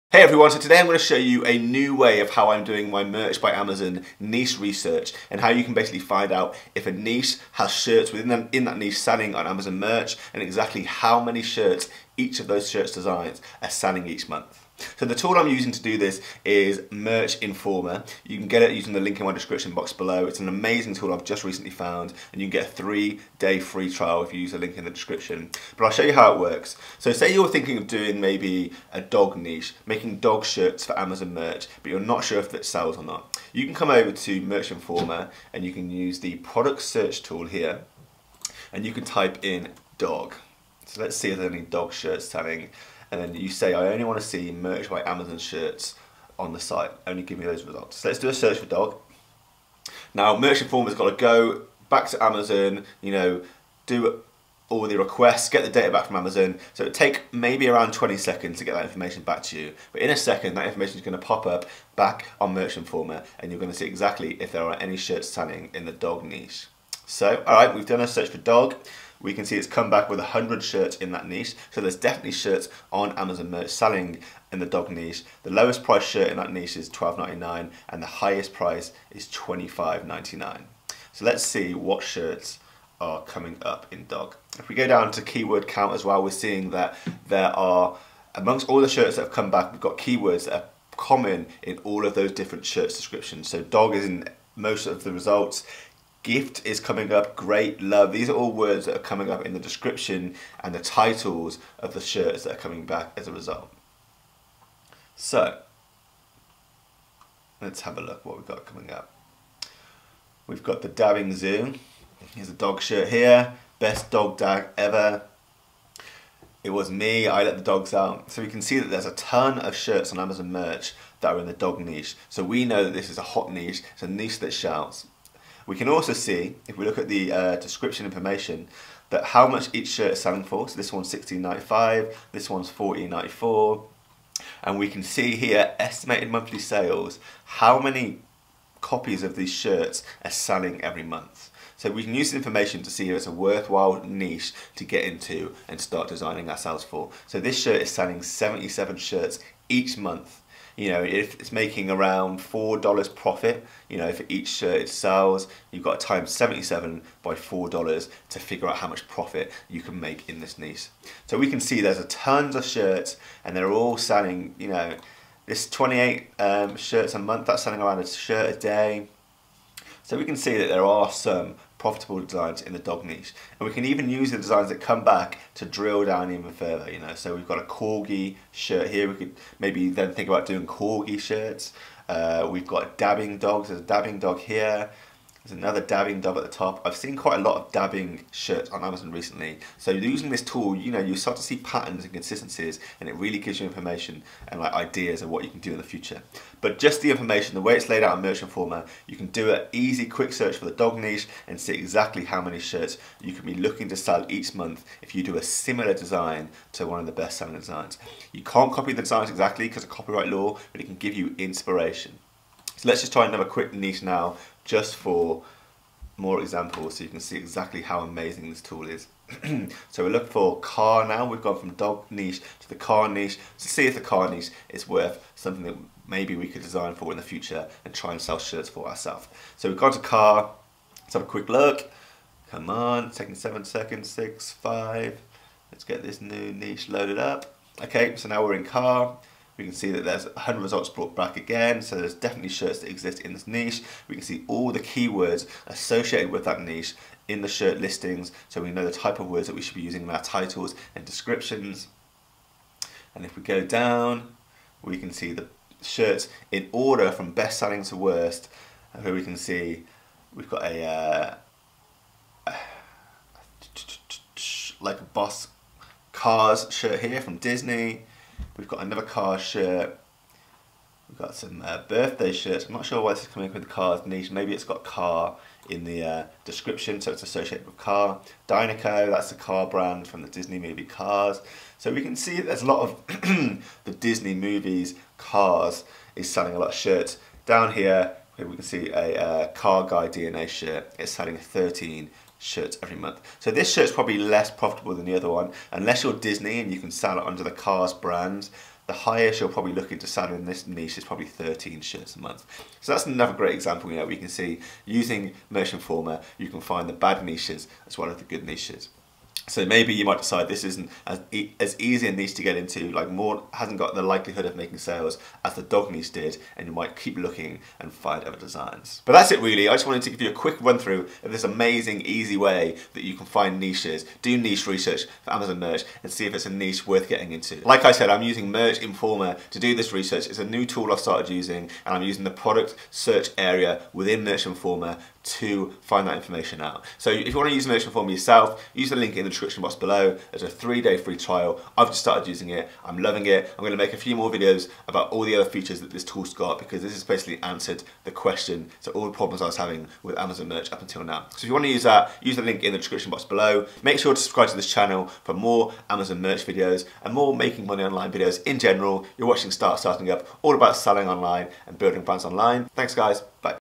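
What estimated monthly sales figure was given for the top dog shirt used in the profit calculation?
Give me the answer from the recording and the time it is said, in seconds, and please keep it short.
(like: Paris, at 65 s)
77, at 148 s.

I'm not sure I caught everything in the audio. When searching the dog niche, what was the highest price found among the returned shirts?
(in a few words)
$25.99.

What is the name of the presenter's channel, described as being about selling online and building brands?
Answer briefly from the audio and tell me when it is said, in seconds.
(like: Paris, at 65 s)
Start Starting Up, at 359 s.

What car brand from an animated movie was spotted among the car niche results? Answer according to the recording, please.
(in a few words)
Dynaco.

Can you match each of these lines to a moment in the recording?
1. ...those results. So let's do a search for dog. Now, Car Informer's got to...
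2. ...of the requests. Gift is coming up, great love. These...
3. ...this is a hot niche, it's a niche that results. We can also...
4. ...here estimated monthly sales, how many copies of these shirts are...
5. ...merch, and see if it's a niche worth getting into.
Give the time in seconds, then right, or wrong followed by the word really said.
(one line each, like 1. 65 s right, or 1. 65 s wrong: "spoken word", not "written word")
1. 47 s wrong: "Merch", not "Car"
2. 94 s wrong: "results", not "requests"
3. 122 s wrong: "shouts", not "results"
4. 135 s right
5. 325 s right.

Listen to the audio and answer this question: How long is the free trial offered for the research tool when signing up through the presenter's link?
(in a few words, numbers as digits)
3 days.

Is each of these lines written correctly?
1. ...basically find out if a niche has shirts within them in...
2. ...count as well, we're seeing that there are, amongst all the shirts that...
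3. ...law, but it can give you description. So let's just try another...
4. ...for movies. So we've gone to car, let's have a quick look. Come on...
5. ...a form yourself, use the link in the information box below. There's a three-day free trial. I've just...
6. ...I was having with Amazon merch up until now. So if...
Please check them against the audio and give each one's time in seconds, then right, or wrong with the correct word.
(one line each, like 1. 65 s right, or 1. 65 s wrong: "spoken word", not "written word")
1. 5 s right
2. 85 s right
3. 210 s wrong: "inspiration", not "description"
4. 228 s wrong: "ourselves", not "movies"
5. 337 s wrong: "description", not "information"
6. 349 s right.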